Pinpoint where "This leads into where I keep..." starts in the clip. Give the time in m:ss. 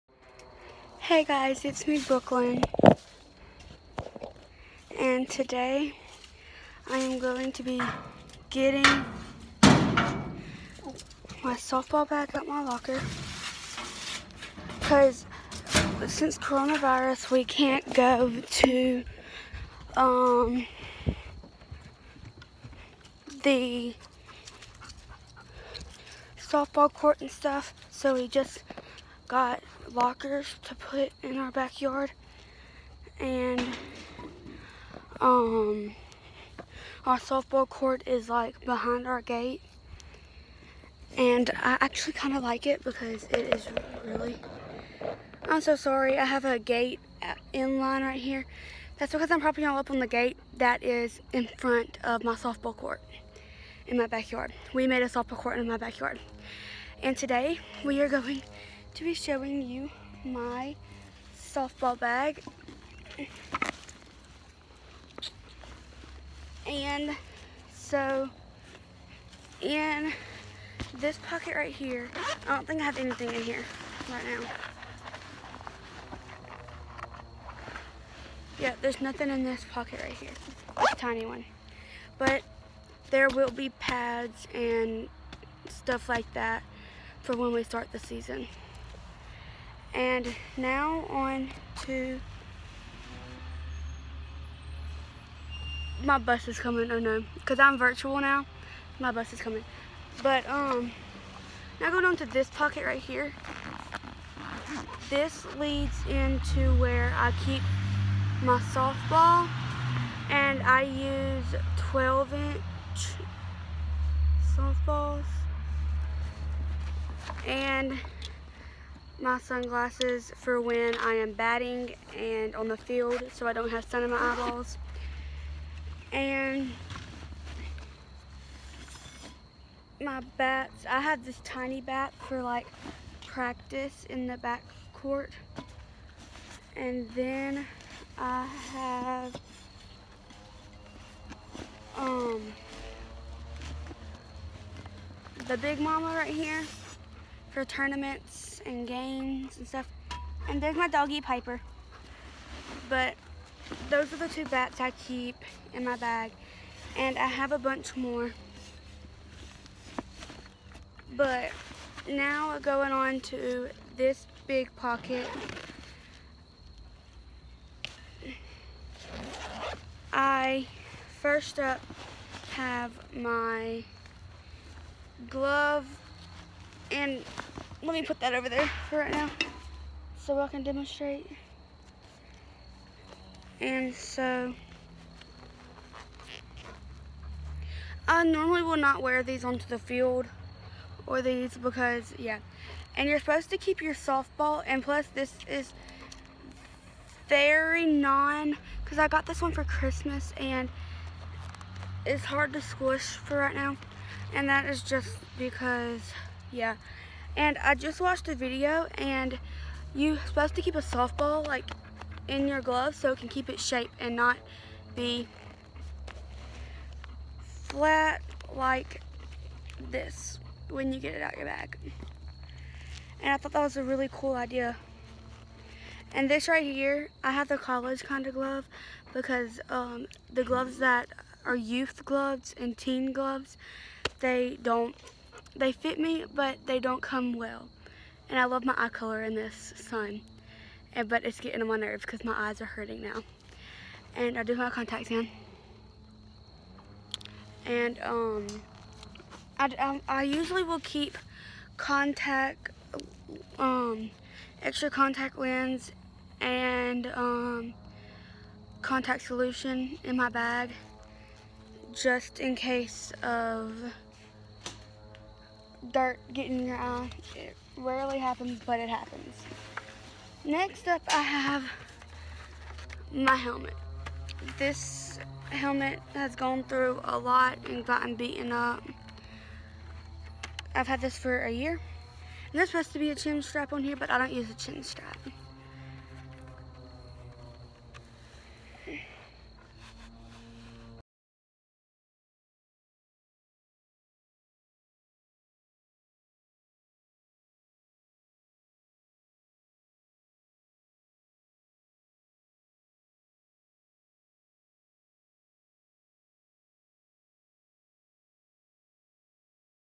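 1:45.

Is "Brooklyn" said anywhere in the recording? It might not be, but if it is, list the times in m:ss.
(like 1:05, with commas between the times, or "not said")
0:01.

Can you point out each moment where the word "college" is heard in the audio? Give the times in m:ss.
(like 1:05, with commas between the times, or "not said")
3:47.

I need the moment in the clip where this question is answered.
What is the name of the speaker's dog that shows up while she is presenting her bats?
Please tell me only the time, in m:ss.
2:31.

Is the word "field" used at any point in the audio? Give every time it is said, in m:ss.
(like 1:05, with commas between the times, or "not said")
2:02, 3:09.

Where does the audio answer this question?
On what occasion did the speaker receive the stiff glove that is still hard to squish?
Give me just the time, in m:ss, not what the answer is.
3:19.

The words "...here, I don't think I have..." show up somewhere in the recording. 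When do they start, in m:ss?
1:11.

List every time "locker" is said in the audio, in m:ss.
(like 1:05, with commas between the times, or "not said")
0:12, 0:29.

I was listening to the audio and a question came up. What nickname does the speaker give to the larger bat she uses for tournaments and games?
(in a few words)
big mama.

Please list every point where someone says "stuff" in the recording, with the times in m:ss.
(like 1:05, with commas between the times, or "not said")
0:27, 1:25, 2:29.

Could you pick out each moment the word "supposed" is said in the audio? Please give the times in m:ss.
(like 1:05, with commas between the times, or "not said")
3:13, 3:30, 4:42.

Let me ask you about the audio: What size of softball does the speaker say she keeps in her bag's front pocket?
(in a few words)
12 inch.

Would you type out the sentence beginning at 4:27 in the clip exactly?
It rarely happens, but it happens.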